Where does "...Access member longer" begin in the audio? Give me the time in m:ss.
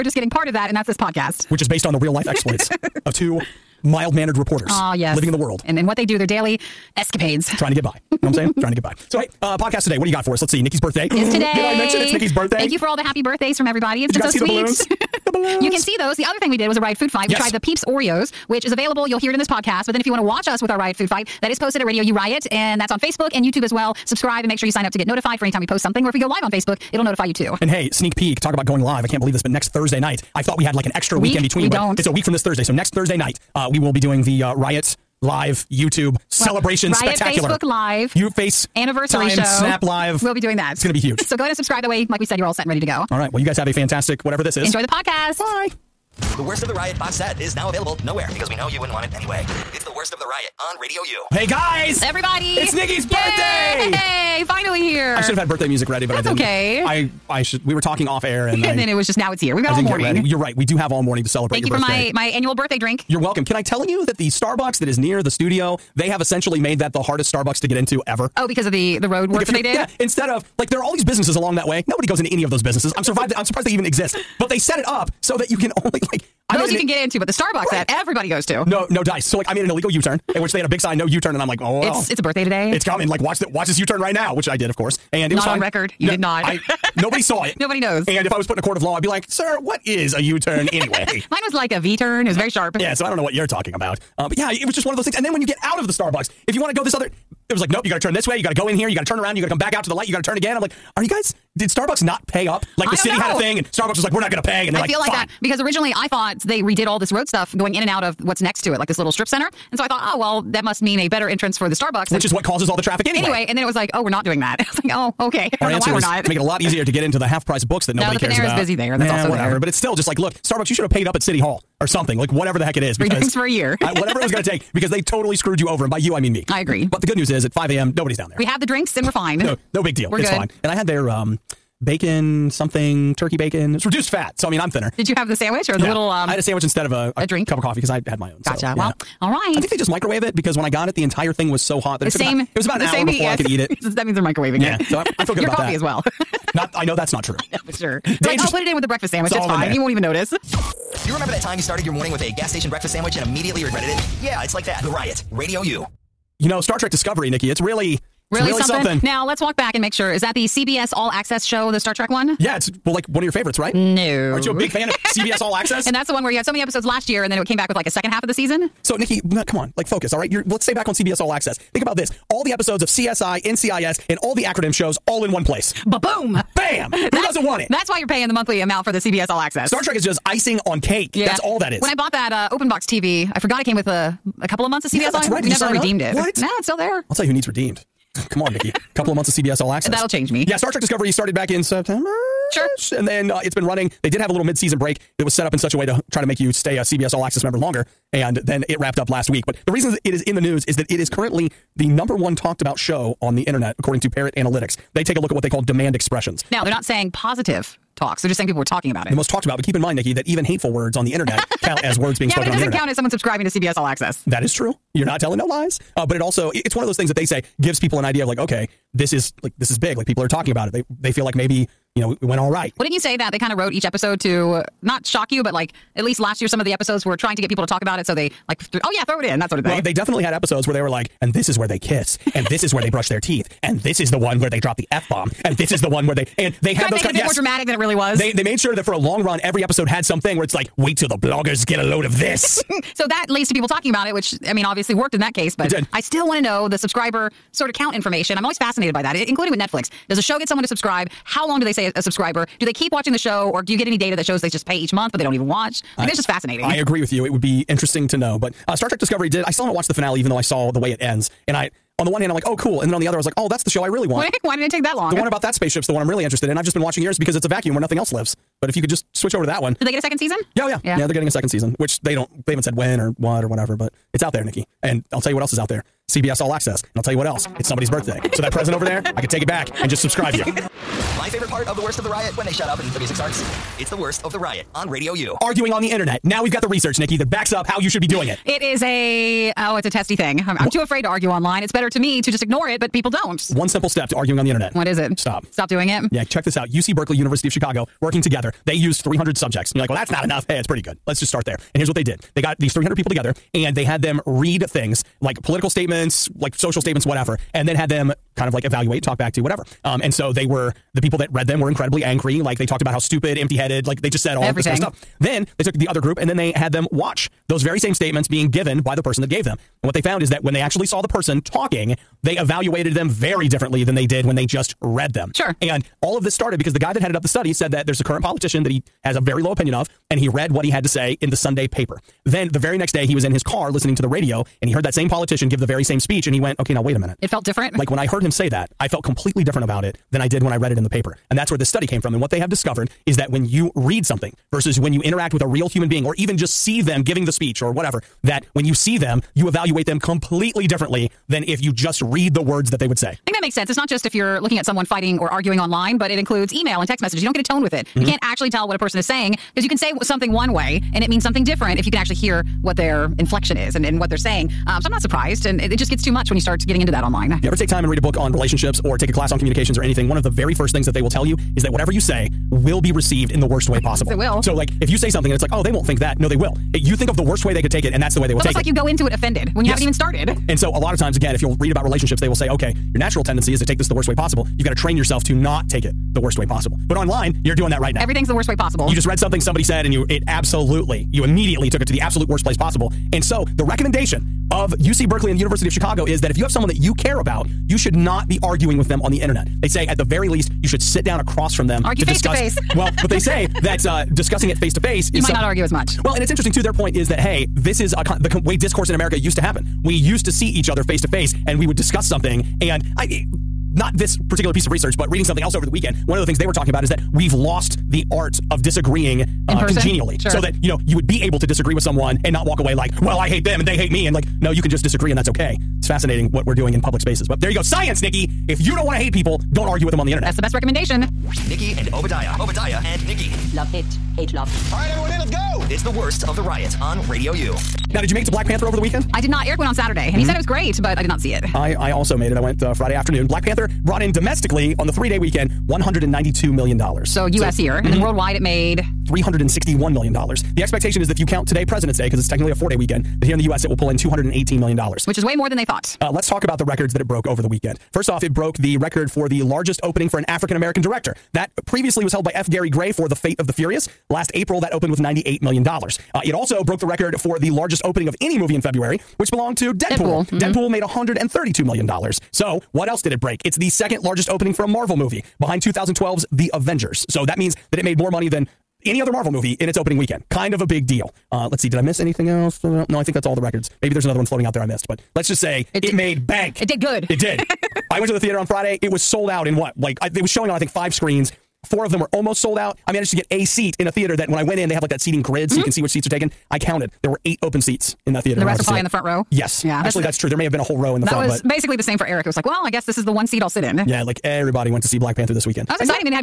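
3:17.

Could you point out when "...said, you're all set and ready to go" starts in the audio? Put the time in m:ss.
0:42.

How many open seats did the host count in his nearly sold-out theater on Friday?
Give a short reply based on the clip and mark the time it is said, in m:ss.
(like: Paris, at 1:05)
8, at 8:17.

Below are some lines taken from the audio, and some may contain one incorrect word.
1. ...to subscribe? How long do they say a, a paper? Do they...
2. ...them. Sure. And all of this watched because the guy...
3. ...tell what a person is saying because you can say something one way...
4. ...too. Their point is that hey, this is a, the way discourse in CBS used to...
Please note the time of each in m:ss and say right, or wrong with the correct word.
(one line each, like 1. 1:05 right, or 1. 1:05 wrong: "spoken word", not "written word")
1. 4:10 wrong: "subscriber", not "paper"
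2. 5:25 wrong: "started", not "watched"
3. 5:58 right
4. 6:46 wrong: "America", not "CBS".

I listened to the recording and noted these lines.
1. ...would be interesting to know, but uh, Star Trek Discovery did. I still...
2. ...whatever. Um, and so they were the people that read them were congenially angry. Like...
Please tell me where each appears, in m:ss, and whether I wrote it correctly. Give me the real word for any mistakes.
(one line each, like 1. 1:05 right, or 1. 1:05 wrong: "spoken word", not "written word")
1. 4:17 right
2. 5:09 wrong: "incredibly", not "congenially".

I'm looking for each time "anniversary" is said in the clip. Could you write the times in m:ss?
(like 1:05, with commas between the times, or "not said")
0:38.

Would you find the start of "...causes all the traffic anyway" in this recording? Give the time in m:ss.
1:52.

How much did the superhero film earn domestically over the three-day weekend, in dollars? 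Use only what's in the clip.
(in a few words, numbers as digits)
$192 million.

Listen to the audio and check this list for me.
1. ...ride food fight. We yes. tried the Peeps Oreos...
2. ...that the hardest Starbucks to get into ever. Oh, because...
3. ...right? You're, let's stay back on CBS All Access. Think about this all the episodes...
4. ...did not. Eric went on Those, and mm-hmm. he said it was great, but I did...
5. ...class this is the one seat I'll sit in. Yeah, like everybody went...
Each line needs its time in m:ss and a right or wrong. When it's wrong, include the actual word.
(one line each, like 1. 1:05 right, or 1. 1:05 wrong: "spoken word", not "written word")
1. 0:16 right
2. 1:06 right
3. 2:50 right
4. 7:19 wrong: "Saturday", not "Those"
5. 8:22 wrong: "guess", not "class".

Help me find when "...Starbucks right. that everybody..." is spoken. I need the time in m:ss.
1:17.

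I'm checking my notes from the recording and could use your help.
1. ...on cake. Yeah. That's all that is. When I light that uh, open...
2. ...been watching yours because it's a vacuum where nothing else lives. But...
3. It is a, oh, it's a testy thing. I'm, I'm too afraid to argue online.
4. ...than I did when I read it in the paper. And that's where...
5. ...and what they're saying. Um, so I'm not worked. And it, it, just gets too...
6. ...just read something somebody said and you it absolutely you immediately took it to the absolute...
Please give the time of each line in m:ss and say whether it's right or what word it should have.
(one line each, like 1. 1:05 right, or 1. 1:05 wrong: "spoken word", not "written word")
1. 3:00 wrong: "bought", not "light"
2. 4:26 right
3. 4:48 right
4. 5:40 right
5. 6:03 wrong: "surprised", not "worked"
6. 6:28 right.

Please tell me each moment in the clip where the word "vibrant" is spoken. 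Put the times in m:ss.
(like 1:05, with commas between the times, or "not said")
not said.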